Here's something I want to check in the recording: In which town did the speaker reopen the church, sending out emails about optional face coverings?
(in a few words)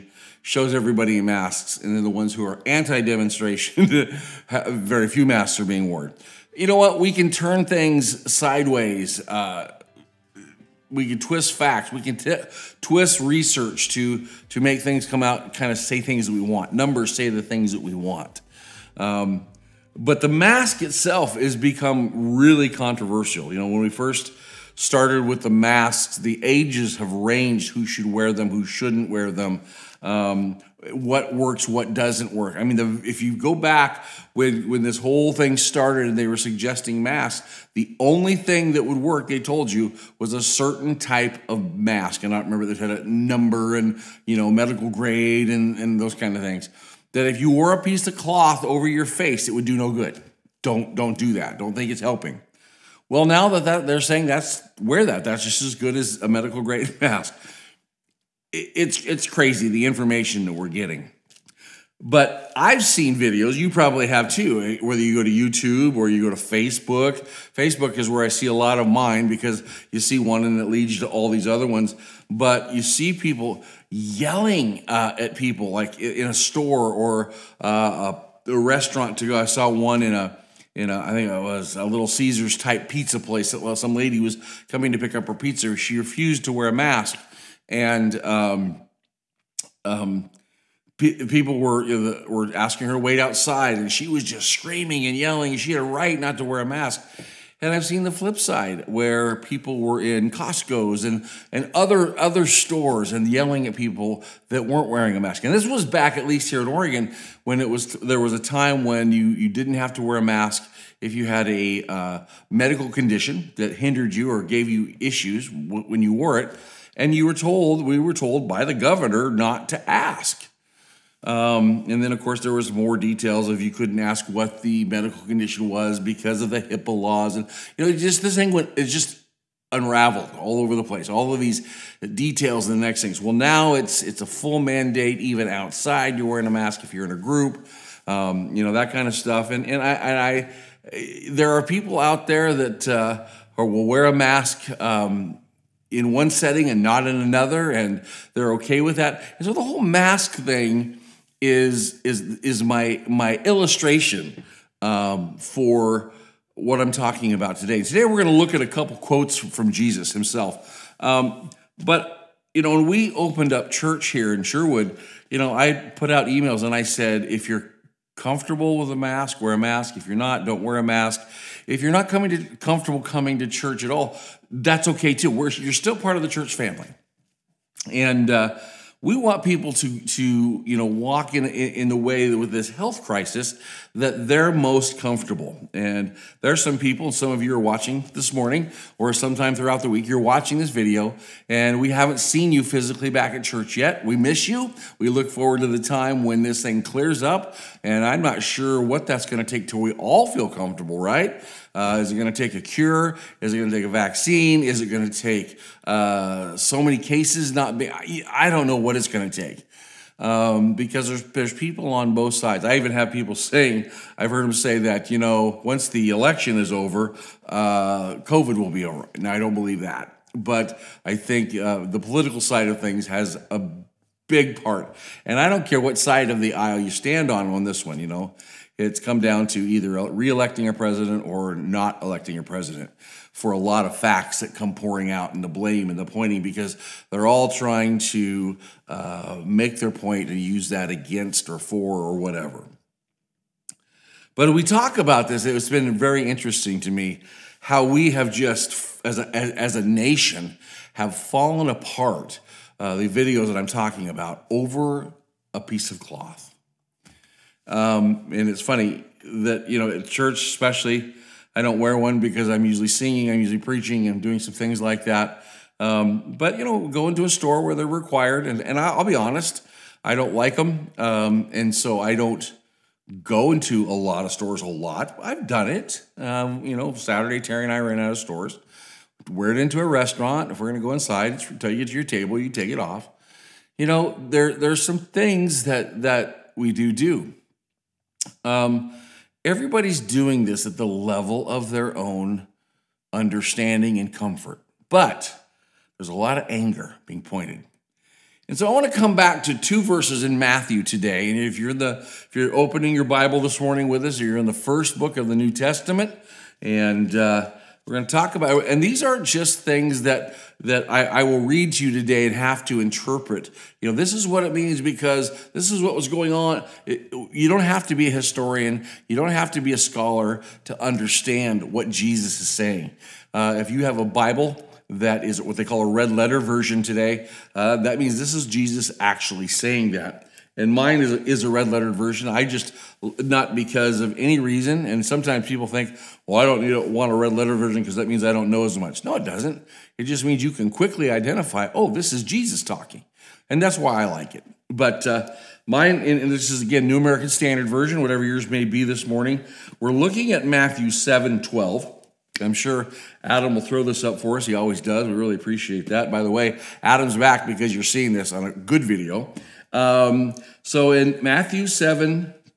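Sherwood.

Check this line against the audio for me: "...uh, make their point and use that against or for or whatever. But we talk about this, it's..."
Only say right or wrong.
right.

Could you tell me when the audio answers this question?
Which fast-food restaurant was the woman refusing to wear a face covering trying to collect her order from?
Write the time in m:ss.
1:21.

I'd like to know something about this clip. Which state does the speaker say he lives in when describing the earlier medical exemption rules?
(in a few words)
Oregon.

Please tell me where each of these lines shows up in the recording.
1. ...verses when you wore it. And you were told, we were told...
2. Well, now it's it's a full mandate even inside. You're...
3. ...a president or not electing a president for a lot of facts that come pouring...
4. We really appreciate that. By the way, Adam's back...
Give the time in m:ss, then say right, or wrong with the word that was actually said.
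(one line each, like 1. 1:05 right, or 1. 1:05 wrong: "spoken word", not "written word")
1. 1:55 wrong: "issues", not "verses"
2. 2:13 wrong: "outside", not "inside"
3. 3:50 right
4. 5:55 right.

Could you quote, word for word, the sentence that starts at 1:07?
Facebook is where I see a lot of mine because you see one and it leads you to all these other ones.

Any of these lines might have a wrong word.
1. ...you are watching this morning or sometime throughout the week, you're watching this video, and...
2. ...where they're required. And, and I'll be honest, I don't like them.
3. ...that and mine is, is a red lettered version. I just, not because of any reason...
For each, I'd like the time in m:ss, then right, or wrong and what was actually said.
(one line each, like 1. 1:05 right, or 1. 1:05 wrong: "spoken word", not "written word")
1. 3:07 right
2. 4:27 right
3. 5:29 right.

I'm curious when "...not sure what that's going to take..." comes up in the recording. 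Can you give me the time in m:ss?
3:18.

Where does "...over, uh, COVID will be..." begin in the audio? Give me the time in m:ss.
3:36.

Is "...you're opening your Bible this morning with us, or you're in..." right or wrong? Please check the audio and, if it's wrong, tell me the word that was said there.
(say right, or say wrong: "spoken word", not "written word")
right.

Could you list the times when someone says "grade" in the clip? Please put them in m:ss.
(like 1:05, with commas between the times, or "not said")
0:44, 0:56.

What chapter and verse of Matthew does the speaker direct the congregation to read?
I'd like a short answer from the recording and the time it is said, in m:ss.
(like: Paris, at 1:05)
Matthew 7:12, at 5:50.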